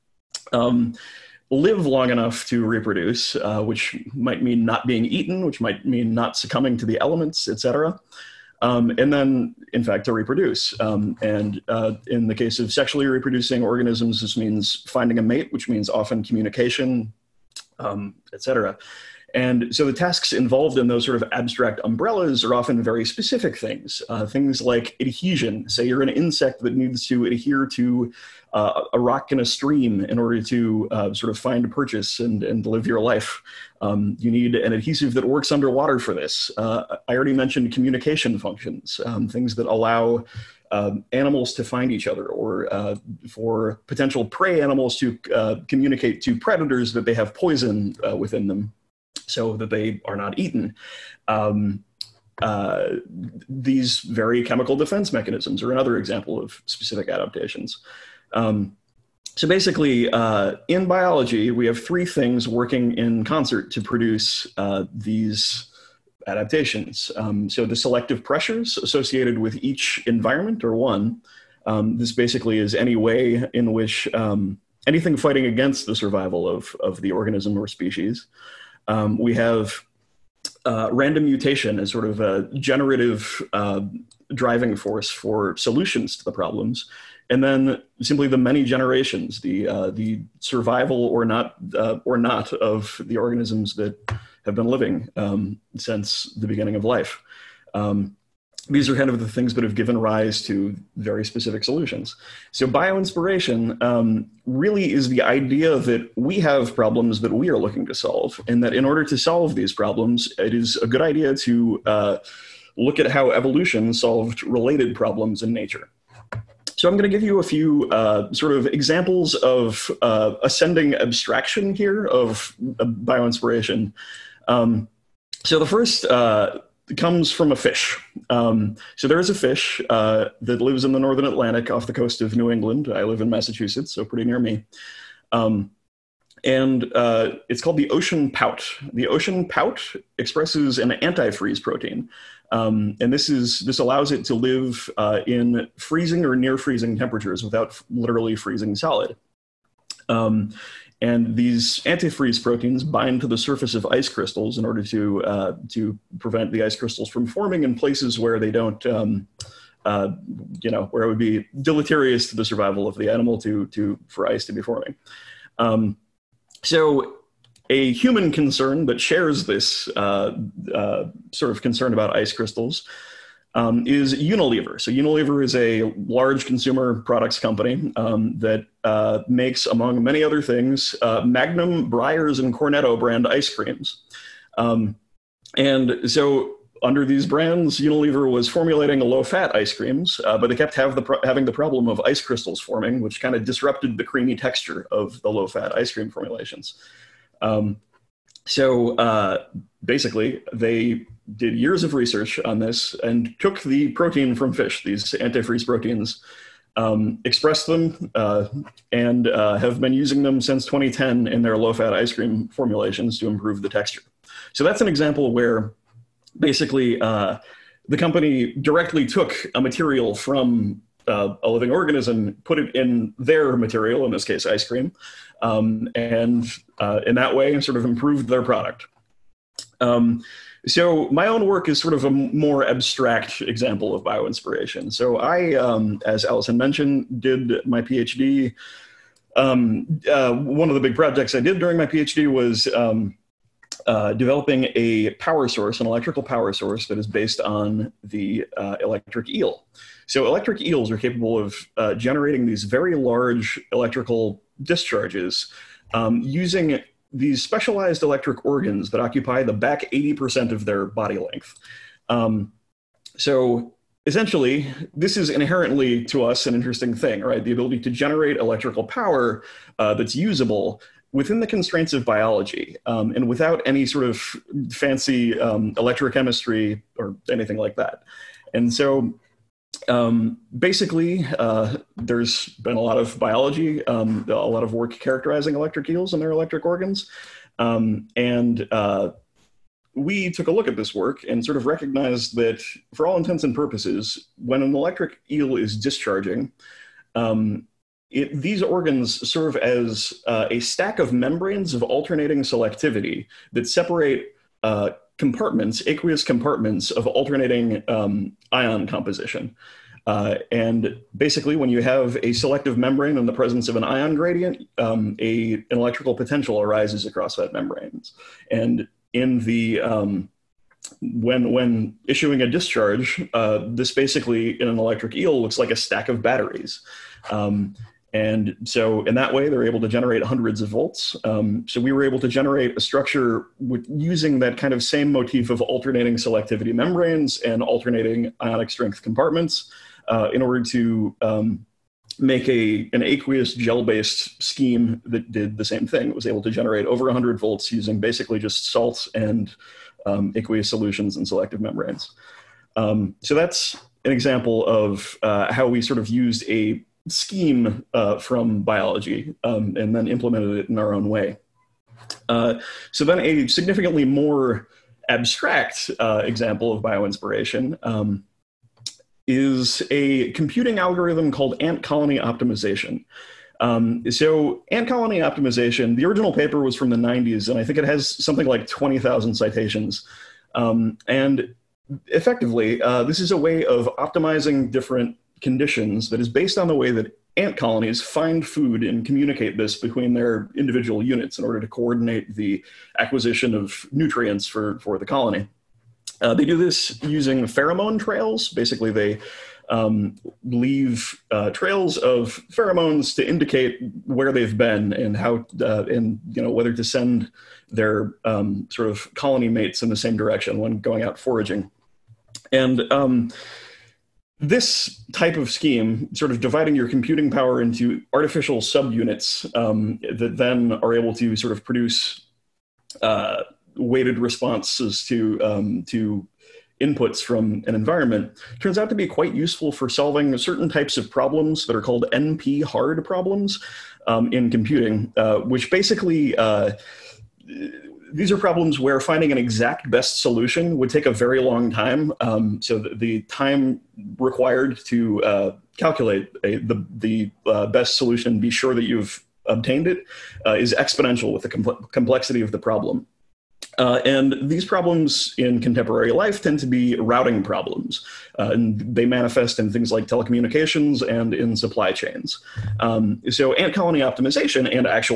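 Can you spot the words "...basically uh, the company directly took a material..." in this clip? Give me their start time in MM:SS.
03:36.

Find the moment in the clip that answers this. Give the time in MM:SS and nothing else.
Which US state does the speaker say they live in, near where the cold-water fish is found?
02:13.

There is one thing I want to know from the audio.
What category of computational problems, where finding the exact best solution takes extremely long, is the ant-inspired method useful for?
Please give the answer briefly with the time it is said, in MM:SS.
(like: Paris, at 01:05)
NP hard problems, at 07:12.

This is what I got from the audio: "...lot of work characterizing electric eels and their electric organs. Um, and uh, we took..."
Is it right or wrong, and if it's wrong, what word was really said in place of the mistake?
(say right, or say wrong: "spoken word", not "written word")
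right.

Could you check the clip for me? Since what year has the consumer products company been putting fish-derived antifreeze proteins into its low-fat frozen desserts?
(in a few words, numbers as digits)
2010.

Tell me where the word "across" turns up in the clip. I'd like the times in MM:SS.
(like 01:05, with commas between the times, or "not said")
05:17.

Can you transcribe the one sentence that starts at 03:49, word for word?
Um, so my own work is sort of a more abstract example of bioinspiration.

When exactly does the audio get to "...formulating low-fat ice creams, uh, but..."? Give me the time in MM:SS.
03:08.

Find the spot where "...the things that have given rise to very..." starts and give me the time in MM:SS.
01:39.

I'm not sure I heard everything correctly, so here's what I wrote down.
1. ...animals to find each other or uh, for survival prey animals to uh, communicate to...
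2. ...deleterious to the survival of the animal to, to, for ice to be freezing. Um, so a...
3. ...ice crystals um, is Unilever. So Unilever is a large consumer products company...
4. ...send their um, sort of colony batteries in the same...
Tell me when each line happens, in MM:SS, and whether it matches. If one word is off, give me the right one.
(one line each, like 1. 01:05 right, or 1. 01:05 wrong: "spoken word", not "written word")
1. 00:41 wrong: "potential", not "survival"
2. 02:41 wrong: "forming", not "freezing"
3. 02:52 right
4. 06:46 wrong: "mates", not "batteries".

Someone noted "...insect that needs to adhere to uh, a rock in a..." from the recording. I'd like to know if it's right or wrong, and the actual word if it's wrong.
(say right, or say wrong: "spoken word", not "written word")
right.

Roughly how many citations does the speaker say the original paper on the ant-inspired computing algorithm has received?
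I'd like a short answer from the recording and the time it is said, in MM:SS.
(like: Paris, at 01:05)
20,000, at 06:18.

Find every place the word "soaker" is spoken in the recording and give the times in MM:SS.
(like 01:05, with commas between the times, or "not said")
not said.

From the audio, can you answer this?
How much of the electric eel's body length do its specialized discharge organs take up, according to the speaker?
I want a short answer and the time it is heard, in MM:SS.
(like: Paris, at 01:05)
back 80%, at 04:19.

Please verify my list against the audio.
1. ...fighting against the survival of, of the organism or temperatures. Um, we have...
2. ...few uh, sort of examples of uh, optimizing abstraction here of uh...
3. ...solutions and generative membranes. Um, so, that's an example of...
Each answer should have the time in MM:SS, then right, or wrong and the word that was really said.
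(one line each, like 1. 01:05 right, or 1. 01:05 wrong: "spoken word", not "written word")
1. 01:15 wrong: "species", not "temperatures"
2. 01:57 wrong: "ascending", not "optimizing"
3. 05:50 wrong: "selective", not "generative".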